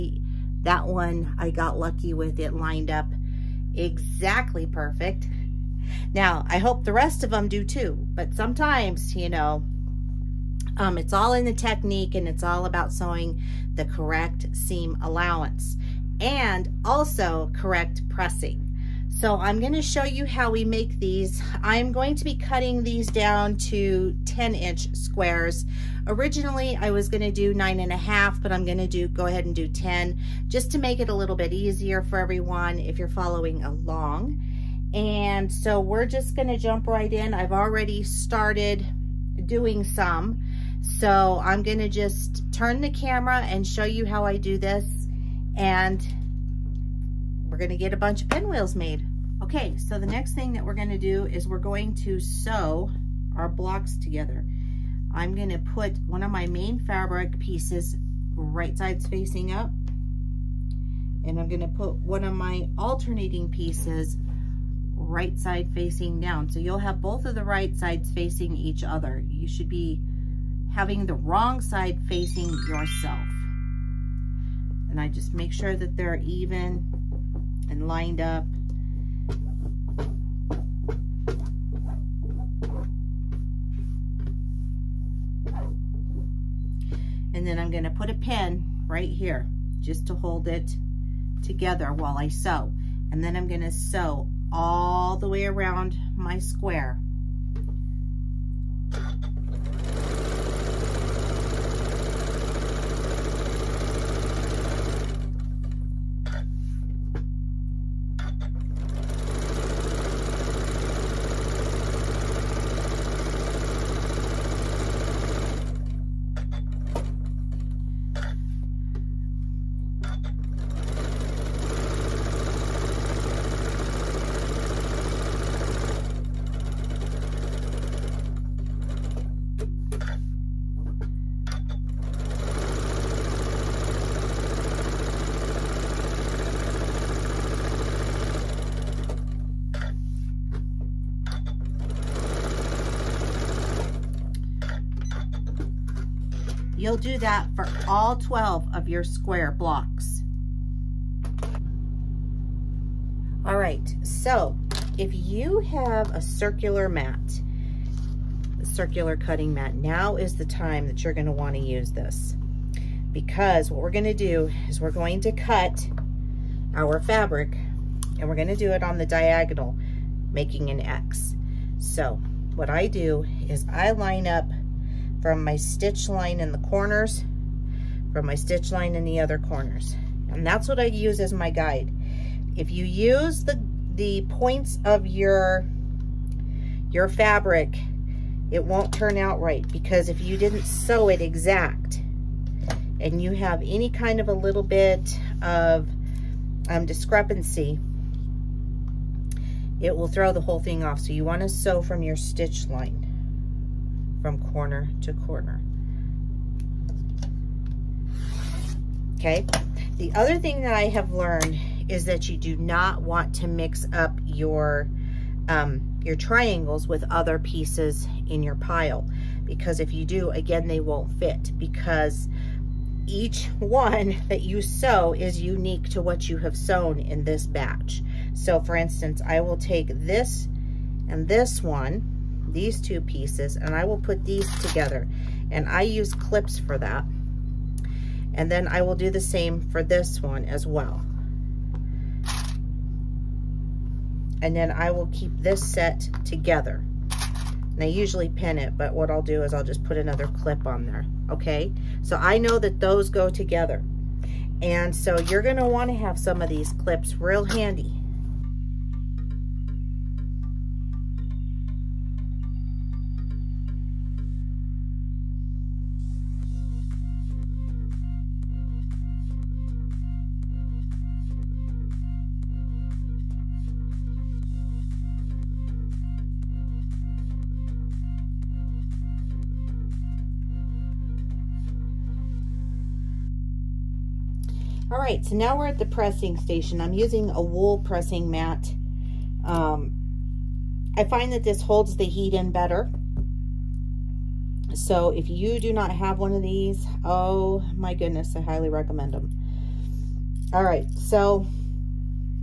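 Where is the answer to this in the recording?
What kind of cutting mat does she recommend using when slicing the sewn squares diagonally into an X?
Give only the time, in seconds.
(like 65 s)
158 s.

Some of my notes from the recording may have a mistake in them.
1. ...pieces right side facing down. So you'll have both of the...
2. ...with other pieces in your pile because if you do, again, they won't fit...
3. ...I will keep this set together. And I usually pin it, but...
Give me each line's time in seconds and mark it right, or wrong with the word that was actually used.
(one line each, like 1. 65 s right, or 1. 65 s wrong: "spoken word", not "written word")
1. 63 s right
2. 216 s right
3. 244 s right.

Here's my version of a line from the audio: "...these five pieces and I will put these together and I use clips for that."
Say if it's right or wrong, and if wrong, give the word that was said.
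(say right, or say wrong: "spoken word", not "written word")
wrong: "two", not "five".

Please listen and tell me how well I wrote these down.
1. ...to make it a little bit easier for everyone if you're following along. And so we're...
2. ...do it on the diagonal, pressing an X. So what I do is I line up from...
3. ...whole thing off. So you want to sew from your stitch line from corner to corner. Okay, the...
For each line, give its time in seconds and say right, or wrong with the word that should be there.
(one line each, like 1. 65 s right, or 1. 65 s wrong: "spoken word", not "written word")
1. 30 s right
2. 168 s wrong: "making", not "pressing"
3. 200 s right.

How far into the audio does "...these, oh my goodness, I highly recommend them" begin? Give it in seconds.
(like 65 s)
296 s.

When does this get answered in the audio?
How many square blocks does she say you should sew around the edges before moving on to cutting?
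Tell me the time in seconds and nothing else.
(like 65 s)
148 s.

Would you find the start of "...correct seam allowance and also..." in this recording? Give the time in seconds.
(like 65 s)
13 s.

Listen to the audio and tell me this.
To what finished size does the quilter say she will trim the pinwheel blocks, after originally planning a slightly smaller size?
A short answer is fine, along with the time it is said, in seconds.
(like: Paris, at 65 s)
10 inch squares, at 24 s.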